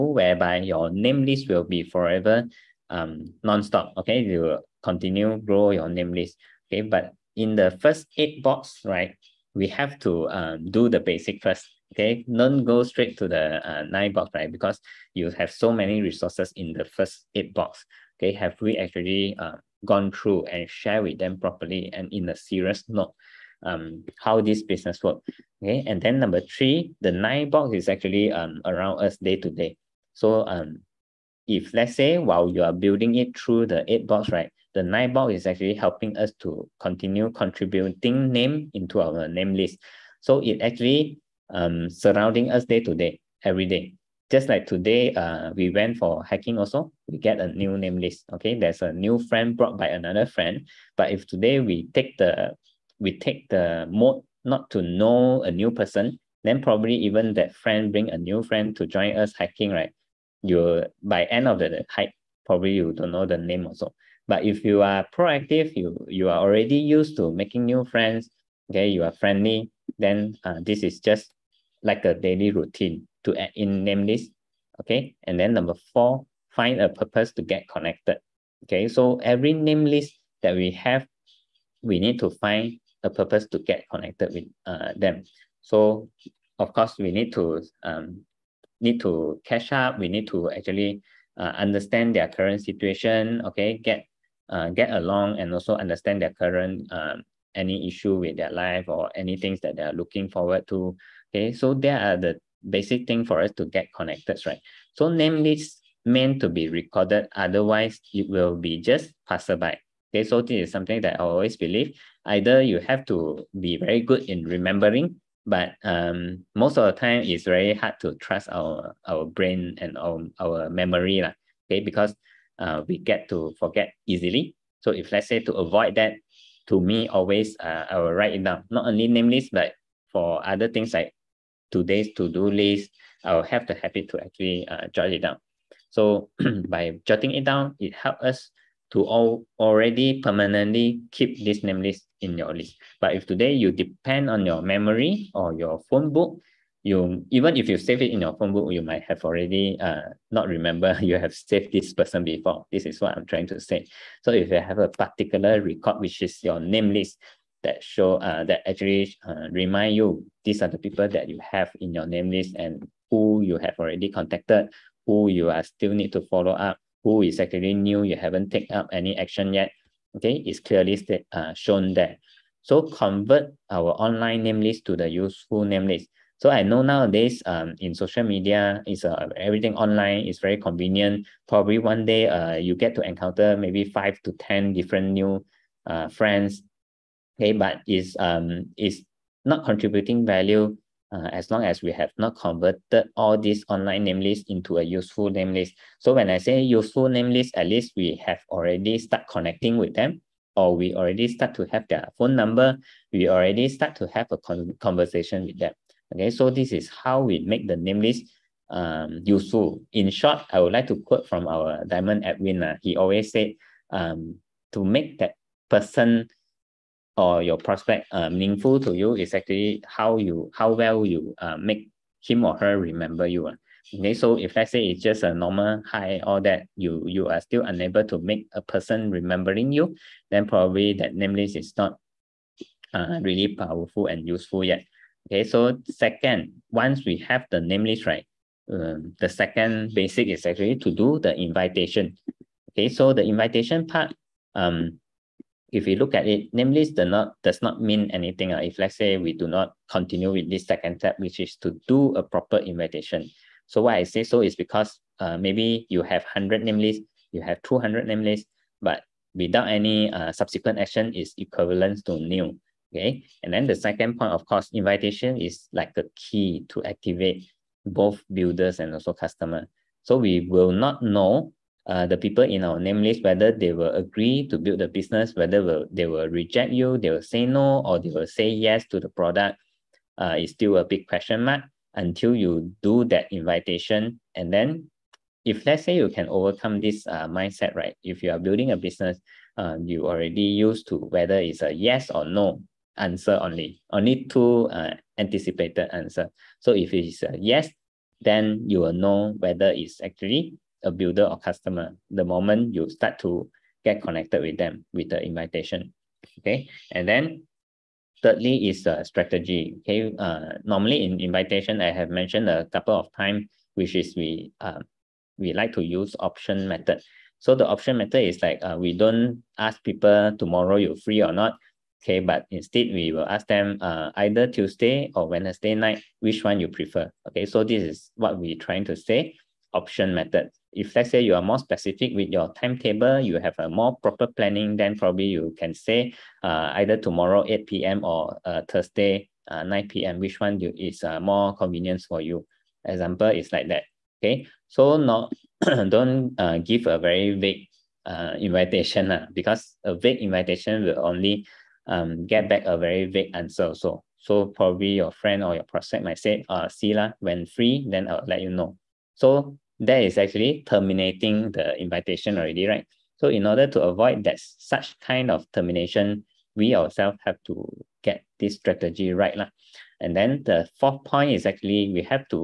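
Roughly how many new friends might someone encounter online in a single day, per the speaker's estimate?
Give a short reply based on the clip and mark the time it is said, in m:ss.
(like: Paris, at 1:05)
5 to 10, at 3:03.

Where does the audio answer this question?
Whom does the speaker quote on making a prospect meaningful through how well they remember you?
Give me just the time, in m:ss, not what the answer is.
3:31.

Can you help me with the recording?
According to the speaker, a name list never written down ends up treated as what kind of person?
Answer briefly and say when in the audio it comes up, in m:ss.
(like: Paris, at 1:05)
Passerby, at 1:49.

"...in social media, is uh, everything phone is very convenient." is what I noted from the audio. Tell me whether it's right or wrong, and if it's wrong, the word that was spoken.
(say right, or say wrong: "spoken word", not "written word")
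wrong: "online", not "phone".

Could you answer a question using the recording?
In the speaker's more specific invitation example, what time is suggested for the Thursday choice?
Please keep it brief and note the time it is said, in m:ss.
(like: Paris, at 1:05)
9 p.m., at 5:39.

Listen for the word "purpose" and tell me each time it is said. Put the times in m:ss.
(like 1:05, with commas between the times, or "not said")
1:16, 1:23.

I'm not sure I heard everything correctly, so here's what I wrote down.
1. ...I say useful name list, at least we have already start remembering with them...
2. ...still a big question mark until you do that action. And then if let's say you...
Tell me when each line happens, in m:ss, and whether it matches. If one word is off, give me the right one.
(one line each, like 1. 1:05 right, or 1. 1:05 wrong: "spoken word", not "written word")
1. 3:16 wrong: "connecting", not "remembering"
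2. 4:40 wrong: "invitation", not "action".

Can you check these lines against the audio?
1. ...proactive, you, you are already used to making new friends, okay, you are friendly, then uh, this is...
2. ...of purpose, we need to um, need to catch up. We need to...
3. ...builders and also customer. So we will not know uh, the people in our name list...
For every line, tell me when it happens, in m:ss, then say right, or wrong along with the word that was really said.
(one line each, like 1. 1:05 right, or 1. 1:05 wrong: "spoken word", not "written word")
1. 1:05 right
2. 1:26 wrong: "course", not "purpose"
3. 4:28 right.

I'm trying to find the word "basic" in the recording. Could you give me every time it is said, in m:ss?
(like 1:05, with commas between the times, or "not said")
0:10, 1:42, 3:59.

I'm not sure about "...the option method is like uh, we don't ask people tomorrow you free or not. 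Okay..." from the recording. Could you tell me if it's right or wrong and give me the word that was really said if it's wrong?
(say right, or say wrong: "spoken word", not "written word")
right.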